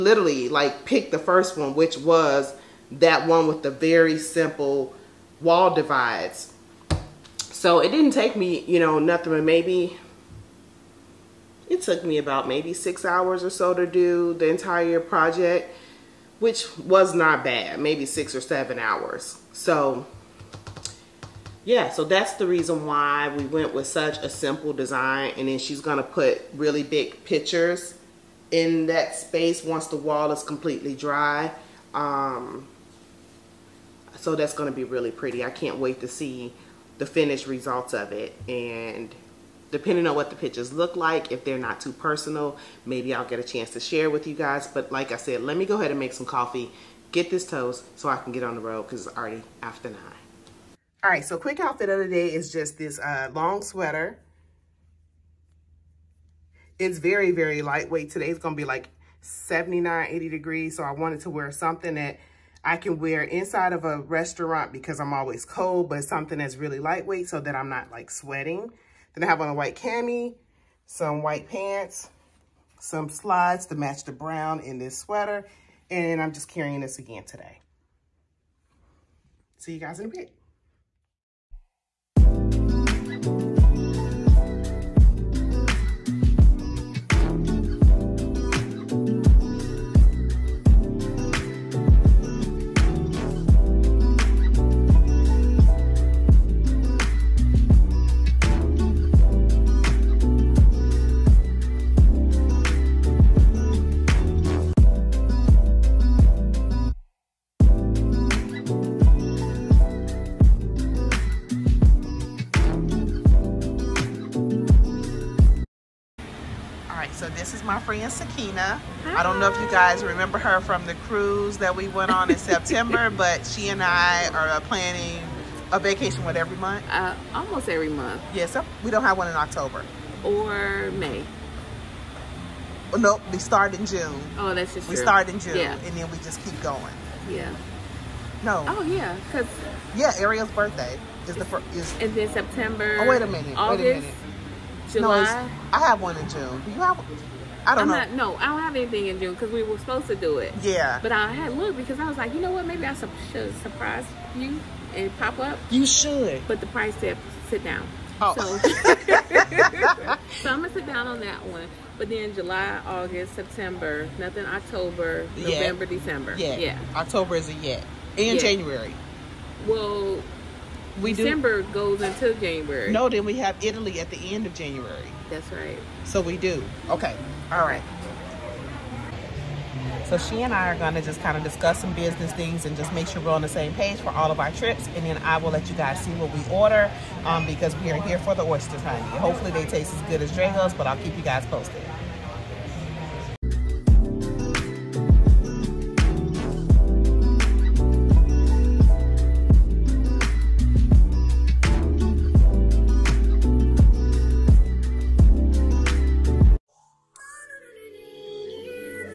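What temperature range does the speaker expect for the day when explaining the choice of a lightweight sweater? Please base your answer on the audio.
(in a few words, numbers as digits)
79-80 degrees.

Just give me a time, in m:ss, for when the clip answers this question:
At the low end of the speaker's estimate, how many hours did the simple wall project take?
0:12.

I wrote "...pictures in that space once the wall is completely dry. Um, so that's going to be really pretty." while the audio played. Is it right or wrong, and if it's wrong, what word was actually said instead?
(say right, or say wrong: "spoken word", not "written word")
right.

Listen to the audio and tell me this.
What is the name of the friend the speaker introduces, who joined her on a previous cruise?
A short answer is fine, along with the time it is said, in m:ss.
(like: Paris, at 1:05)
Sakina, at 1:58.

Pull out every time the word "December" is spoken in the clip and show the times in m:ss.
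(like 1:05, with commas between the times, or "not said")
2:45, 2:51.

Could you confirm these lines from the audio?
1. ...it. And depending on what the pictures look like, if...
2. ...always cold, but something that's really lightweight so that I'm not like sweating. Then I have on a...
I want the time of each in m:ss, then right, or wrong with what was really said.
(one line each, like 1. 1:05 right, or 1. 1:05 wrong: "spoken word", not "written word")
1. 0:38 right
2. 1:05 right.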